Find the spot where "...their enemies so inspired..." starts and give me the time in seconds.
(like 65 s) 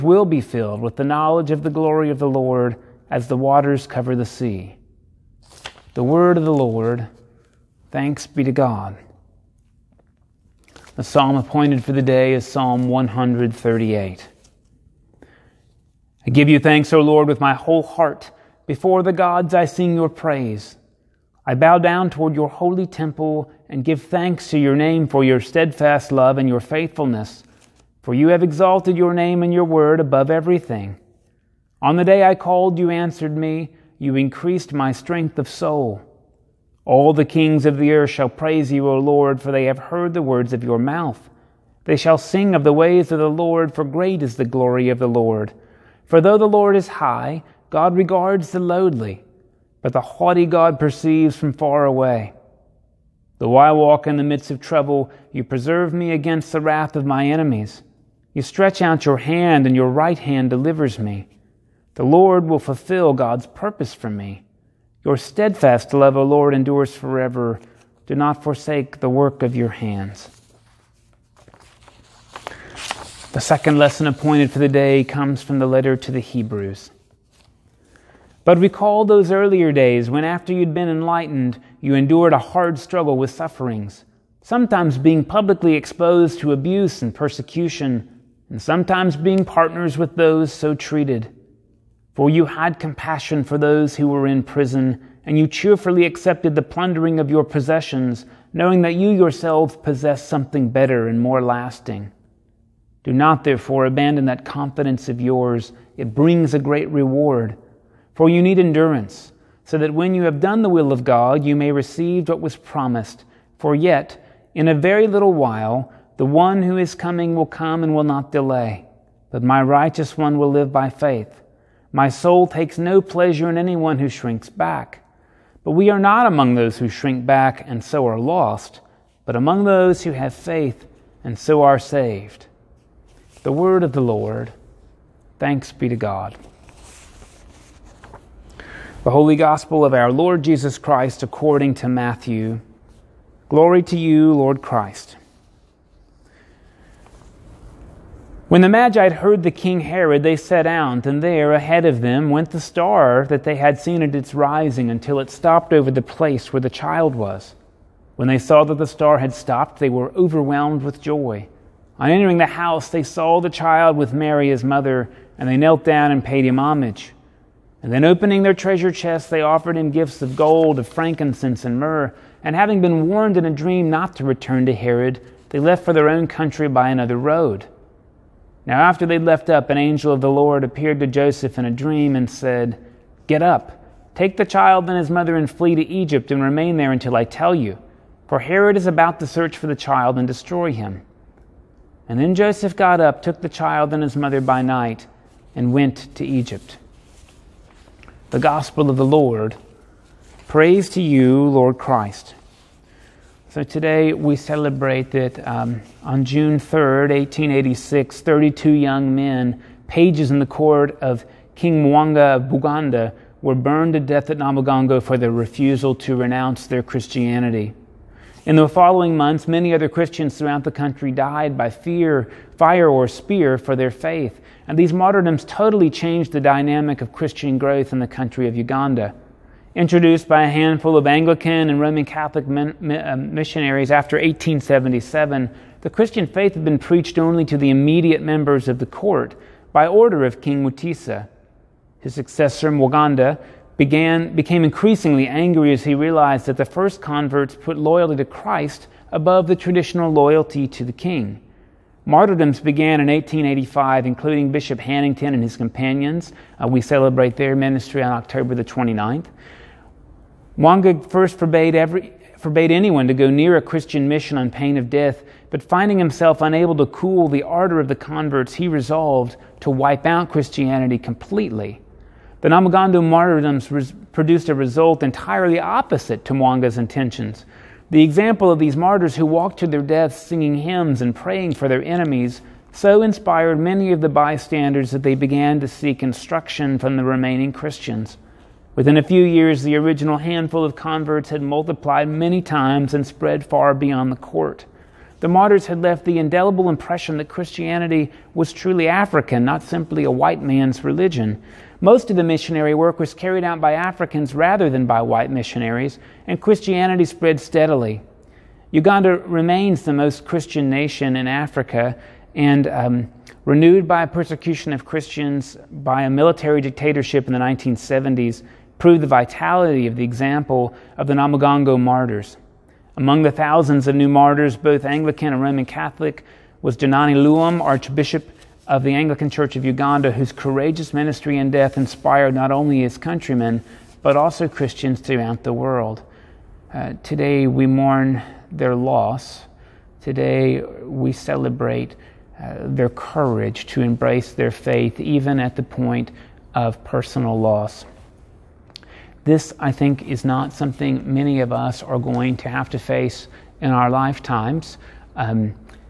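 281 s.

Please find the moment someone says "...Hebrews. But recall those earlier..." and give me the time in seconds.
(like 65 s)
76 s.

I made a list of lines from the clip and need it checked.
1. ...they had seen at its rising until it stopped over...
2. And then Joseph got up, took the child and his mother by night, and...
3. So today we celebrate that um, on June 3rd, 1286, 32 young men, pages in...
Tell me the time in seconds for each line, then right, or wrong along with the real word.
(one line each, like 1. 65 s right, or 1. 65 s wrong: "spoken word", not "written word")
1. 153 s right
2. 192 s right
3. 203 s wrong: "1886", not "1286".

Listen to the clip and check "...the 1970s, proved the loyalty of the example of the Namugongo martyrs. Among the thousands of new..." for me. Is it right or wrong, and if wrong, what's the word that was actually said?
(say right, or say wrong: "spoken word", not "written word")
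wrong: "vitality", not "loyalty".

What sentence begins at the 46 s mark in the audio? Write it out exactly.
For though the Lord is high, God regards the lowly, but the haughty God perceives from far away.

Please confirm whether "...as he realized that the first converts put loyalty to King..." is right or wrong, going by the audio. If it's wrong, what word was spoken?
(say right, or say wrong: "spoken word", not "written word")
wrong: "Christ", not "King".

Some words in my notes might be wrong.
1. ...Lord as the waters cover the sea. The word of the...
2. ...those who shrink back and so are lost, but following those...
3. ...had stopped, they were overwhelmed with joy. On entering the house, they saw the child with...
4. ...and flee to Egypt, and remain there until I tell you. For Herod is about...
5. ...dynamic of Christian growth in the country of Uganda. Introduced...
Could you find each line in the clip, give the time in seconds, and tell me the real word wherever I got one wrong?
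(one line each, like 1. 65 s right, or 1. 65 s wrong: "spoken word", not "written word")
1. 2 s right
2. 126 s wrong: "among", not "following"
3. 159 s right
4. 185 s right
5. 226 s right.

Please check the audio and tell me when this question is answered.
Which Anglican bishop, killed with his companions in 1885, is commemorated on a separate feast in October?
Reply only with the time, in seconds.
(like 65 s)
254 s.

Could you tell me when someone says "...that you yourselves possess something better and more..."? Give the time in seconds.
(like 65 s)
98 s.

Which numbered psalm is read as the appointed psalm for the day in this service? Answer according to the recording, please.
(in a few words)
Psalm 138.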